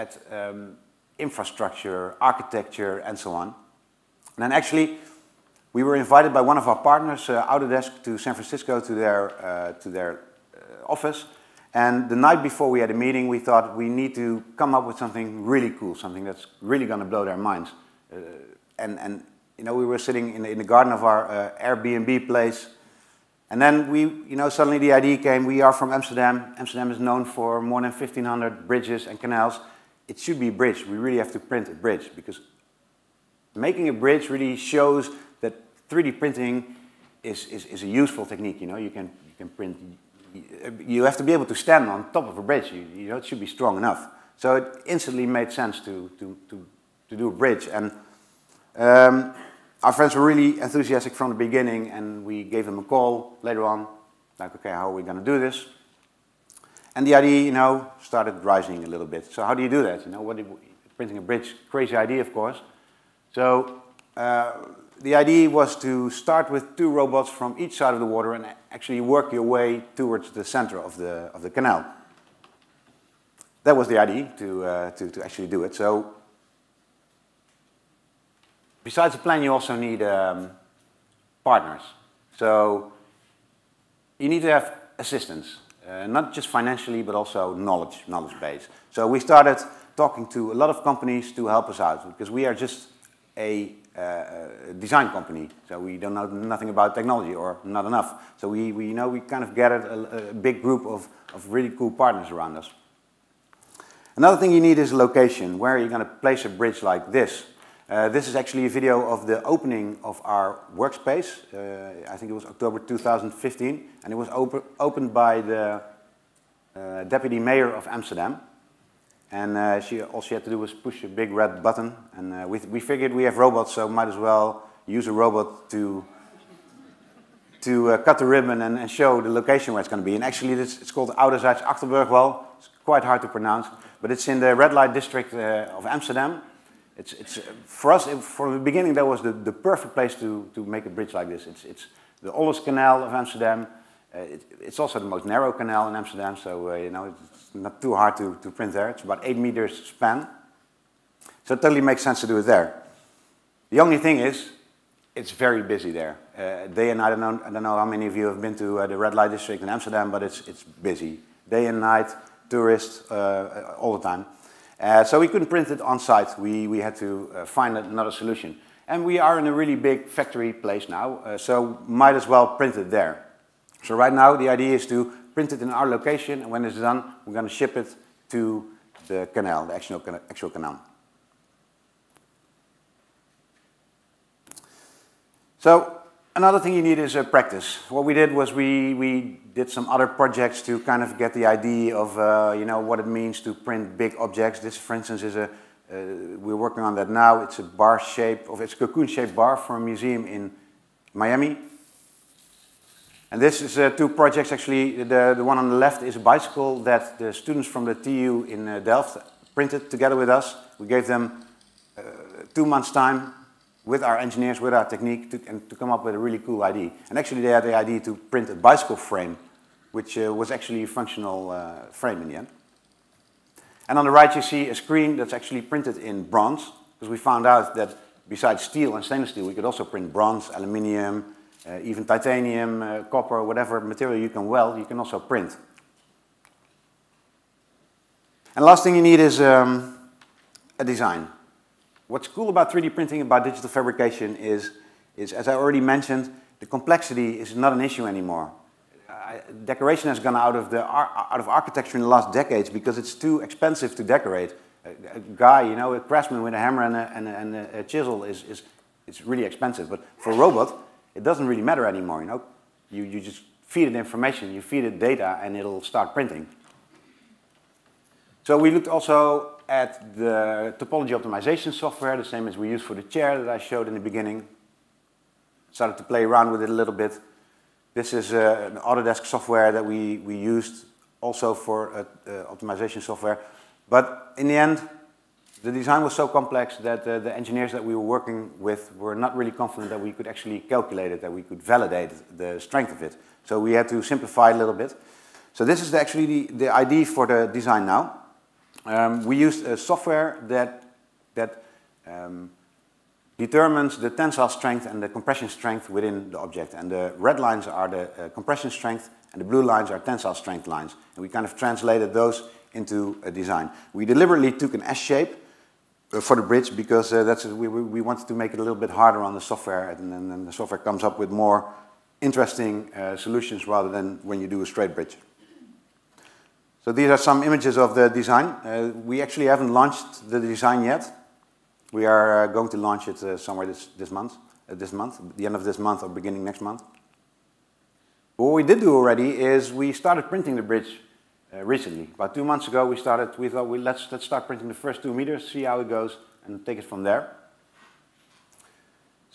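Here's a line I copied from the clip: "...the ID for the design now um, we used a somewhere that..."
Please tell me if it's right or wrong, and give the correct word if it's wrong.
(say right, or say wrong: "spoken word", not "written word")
wrong: "software", not "somewhere".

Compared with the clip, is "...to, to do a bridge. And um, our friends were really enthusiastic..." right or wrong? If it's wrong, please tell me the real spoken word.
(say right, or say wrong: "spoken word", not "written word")
right.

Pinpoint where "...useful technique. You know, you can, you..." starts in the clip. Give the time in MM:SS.
00:37.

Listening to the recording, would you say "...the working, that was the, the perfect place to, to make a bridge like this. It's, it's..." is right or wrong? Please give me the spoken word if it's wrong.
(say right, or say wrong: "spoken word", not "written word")
wrong: "beginning", not "working".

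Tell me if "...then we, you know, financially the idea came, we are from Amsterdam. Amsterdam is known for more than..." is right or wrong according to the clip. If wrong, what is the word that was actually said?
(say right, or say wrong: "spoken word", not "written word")
wrong: "suddenly", not "financially".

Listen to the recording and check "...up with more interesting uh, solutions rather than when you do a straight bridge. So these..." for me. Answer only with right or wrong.
right.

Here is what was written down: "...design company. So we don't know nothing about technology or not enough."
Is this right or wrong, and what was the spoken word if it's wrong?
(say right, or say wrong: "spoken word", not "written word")
right.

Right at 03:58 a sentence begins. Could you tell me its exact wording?
And last thing you need is um, a design.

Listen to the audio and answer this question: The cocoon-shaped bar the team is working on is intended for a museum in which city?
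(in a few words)
Miami.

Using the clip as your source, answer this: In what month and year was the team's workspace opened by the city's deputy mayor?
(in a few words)
October 2015.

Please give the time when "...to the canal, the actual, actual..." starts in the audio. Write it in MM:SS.
02:58.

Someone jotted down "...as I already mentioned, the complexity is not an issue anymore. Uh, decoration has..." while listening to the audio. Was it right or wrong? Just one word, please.
right.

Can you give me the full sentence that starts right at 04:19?
But for a robot, it doesn't really matter anymore, you know.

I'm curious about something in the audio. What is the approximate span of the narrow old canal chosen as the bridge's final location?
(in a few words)
8 meters.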